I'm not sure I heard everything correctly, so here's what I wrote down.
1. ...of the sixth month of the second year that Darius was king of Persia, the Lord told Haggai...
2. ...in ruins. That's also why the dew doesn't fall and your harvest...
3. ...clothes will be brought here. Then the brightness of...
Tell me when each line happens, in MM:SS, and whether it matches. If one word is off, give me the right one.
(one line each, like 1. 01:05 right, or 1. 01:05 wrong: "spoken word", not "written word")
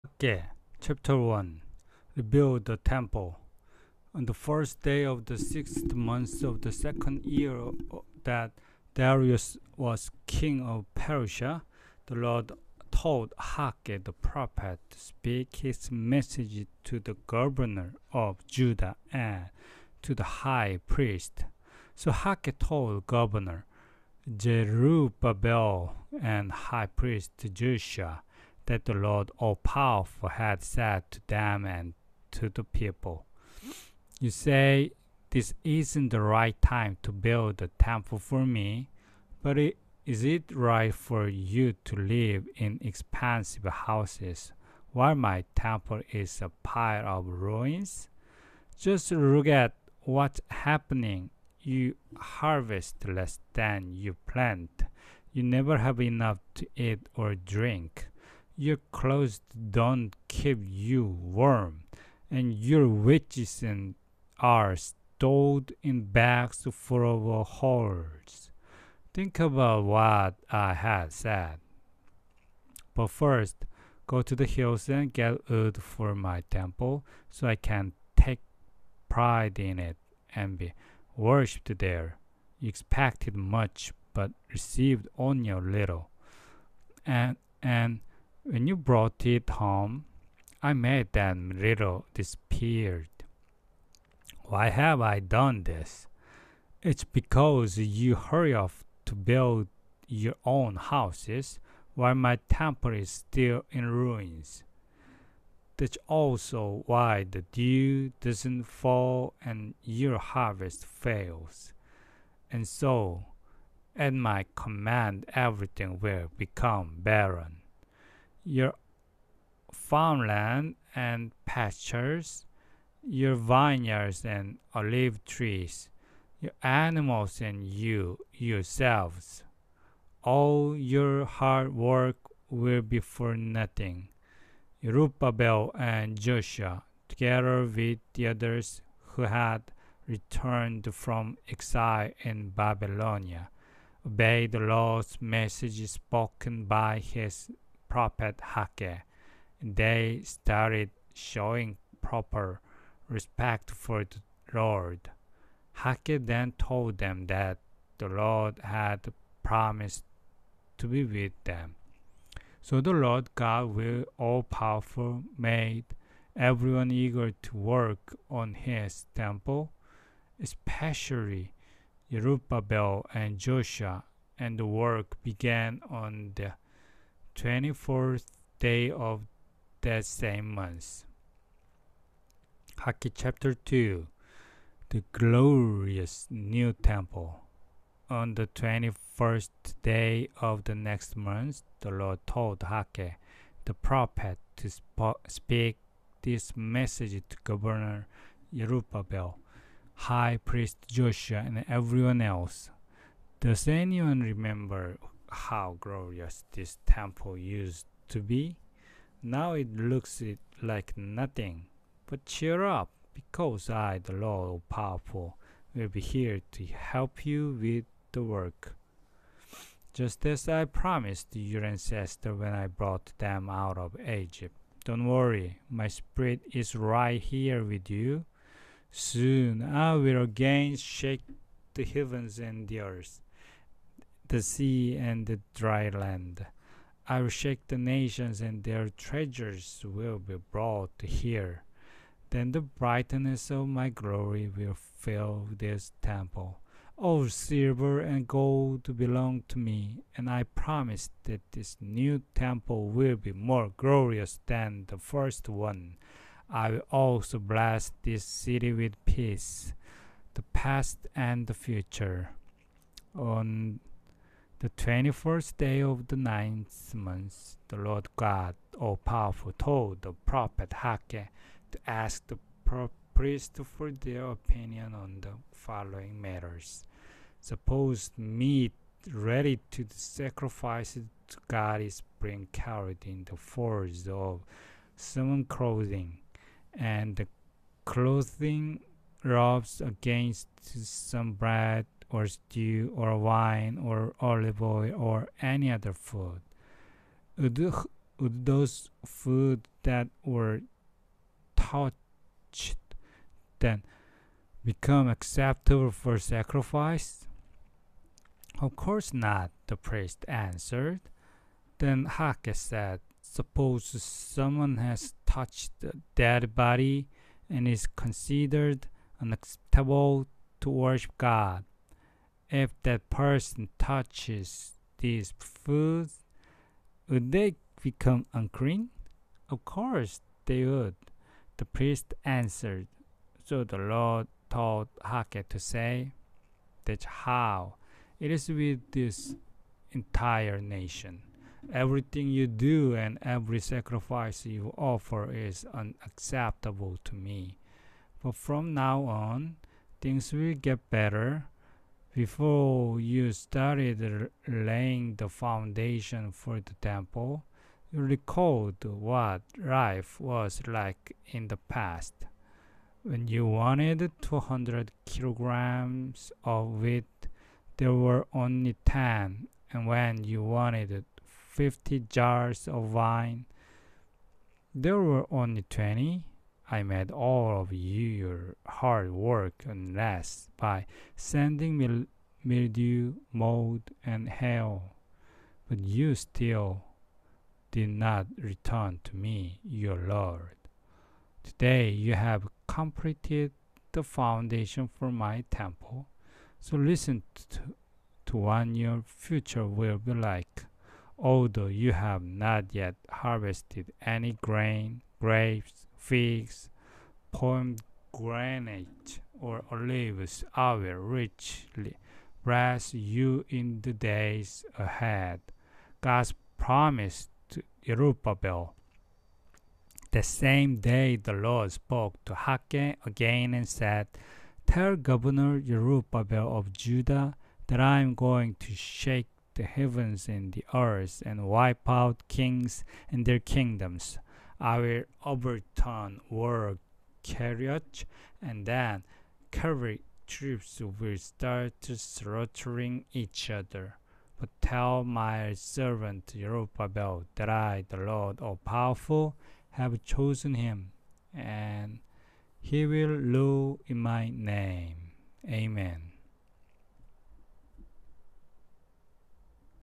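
1. 00:05 right
2. 01:43 right
3. 03:58 wrong: "treasures", not "clothes".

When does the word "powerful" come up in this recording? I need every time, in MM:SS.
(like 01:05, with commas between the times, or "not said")
00:29, 02:44, 03:34, 04:28, 07:28.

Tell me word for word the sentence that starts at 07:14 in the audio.
I will overturn war carriage and then cavalry troops will start slaughtering each other.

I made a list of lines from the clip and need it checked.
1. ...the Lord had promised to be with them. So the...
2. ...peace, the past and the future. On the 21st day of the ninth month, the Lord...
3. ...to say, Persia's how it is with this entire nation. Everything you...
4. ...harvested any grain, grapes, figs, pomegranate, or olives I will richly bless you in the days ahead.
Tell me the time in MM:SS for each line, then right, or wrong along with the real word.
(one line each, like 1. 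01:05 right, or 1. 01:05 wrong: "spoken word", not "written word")
1. 02:37 right
2. 04:19 right
3. 05:35 wrong: "That", not "Persia"
4. 06:43 right.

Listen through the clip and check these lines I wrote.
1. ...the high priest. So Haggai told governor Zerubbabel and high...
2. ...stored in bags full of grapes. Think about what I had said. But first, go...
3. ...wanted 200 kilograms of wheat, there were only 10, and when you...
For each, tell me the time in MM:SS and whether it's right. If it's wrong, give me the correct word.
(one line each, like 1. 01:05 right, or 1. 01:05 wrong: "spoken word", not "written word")
1. 00:20 right
2. 01:04 wrong: "holes", not "grapes"
3. 06:03 right.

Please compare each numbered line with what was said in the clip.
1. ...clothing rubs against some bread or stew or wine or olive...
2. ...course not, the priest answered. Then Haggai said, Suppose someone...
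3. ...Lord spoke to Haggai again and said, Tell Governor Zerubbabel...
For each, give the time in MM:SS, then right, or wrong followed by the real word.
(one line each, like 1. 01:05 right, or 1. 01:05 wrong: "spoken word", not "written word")
1. 04:47 right
2. 05:08 right
3. 07:01 right.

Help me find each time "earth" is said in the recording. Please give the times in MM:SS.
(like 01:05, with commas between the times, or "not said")
03:52, 07:10.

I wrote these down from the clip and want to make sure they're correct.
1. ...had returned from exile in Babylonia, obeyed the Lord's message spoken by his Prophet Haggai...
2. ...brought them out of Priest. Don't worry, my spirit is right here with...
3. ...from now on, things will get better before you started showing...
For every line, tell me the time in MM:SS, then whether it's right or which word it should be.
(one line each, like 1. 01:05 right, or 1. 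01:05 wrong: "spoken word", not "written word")
1. 02:19 right
2. 03:42 wrong: "Egypt", not "Priest"
3. 05:48 wrong: "laying", not "showing".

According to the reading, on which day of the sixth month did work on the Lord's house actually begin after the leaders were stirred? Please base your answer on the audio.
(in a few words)
24th.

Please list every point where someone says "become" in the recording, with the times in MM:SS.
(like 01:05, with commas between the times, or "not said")
01:56, 05:04, 05:27.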